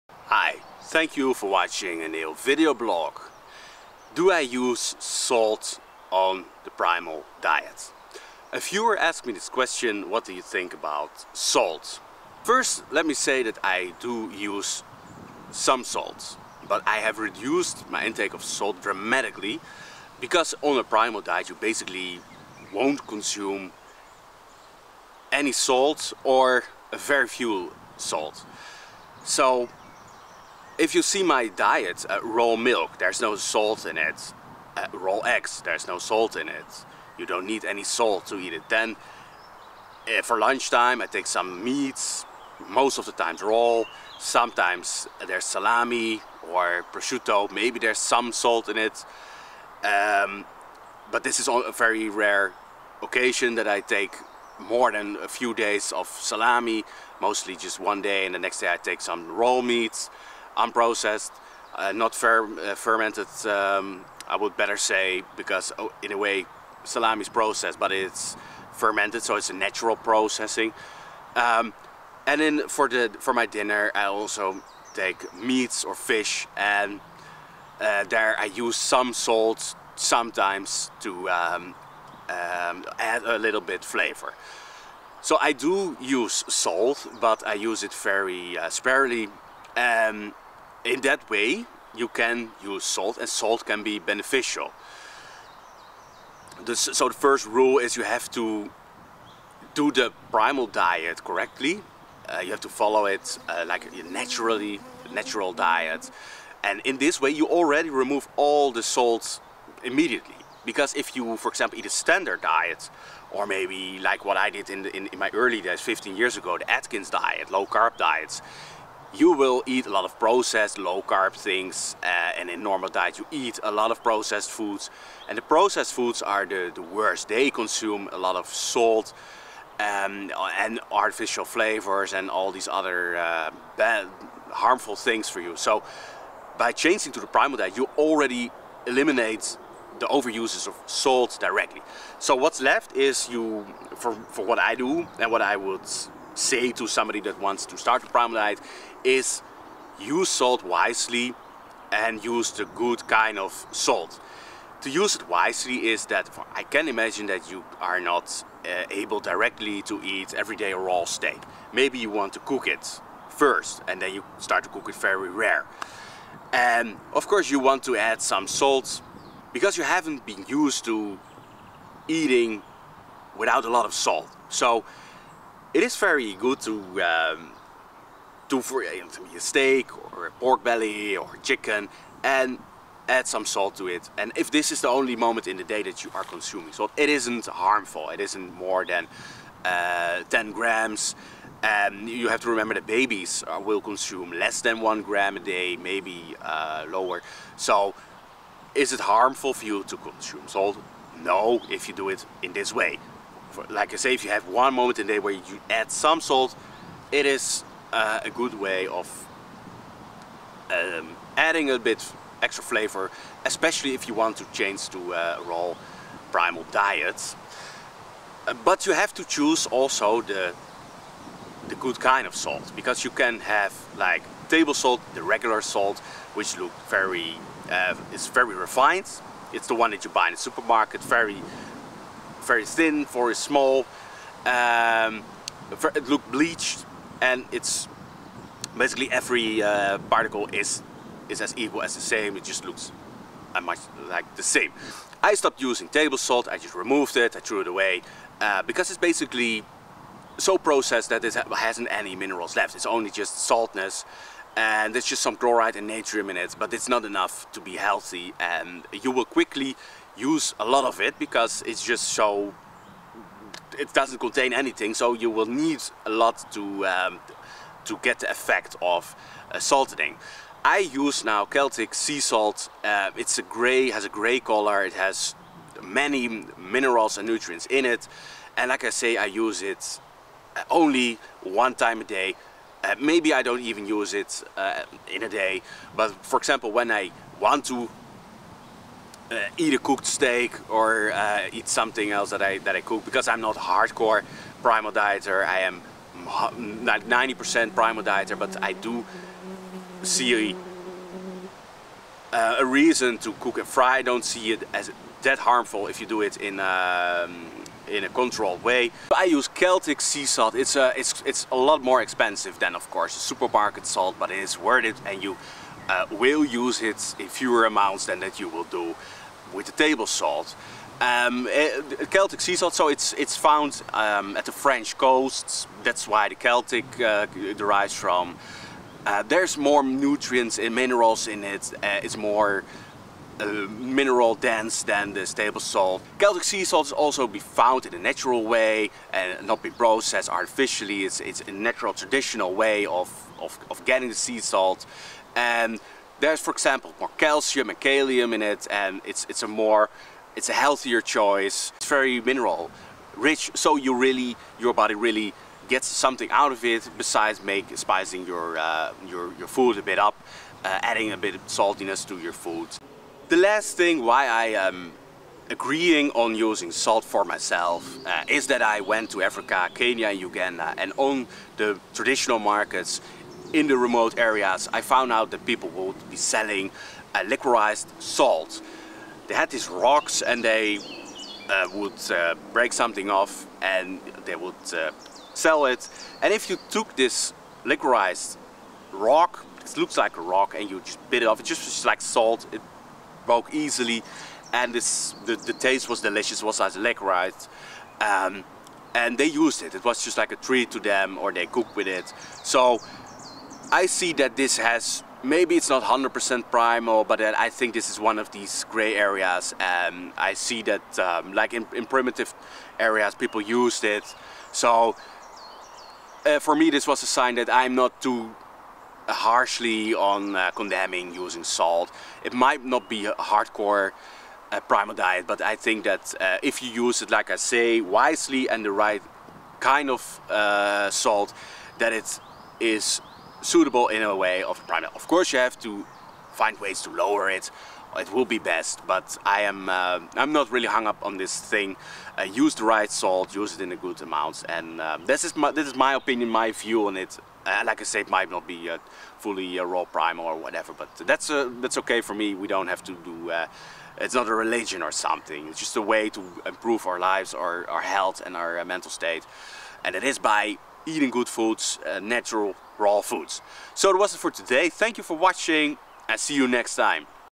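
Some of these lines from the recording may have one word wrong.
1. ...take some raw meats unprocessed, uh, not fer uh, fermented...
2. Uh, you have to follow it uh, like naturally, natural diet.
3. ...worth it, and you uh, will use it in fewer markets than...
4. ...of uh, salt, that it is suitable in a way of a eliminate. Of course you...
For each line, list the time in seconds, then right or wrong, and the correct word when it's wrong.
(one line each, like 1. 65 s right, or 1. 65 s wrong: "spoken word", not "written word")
1. 58 s right
2. 102 s right
3. 314 s wrong: "amounts", not "markets"
4. 429 s wrong: "primate", not "eliminate".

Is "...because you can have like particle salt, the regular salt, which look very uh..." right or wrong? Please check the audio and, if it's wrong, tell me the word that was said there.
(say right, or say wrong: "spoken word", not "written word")
wrong: "table", not "particle".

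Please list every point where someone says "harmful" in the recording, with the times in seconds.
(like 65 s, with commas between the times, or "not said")
134 s, 187 s, 198 s, 305 s.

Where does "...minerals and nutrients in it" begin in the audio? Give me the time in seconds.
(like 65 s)
276 s.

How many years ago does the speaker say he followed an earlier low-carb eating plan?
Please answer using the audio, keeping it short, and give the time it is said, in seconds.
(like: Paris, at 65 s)
15, at 115 s.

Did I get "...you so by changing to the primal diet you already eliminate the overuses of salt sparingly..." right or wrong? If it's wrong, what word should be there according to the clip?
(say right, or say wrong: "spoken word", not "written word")
wrong: "directly", not "sparingly".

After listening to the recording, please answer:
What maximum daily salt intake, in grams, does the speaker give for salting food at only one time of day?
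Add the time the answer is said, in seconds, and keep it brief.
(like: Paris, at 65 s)
10 grams, at 190 s.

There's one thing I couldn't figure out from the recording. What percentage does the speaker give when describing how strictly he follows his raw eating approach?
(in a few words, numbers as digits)
90%.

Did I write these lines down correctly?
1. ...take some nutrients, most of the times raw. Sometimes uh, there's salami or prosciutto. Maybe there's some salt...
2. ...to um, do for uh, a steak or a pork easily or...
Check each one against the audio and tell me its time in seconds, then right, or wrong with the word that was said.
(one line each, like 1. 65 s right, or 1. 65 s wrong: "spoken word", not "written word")
1. 41 s wrong: "meats", not "nutrients"
2. 176 s wrong: "belly", not "easily".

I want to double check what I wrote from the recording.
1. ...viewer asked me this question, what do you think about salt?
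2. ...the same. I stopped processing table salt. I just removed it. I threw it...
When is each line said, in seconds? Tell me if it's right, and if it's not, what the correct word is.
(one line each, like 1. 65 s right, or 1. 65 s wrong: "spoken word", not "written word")
1. 8 s right
2. 244 s wrong: "using", not "processing".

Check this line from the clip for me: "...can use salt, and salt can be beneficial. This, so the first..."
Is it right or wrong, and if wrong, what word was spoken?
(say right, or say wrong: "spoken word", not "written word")
right.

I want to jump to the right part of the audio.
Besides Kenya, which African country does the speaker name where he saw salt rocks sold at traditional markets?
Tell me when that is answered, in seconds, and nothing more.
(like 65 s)
370 s.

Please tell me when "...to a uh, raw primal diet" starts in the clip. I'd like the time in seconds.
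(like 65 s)
214 s.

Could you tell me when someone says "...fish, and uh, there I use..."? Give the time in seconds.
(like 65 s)
75 s.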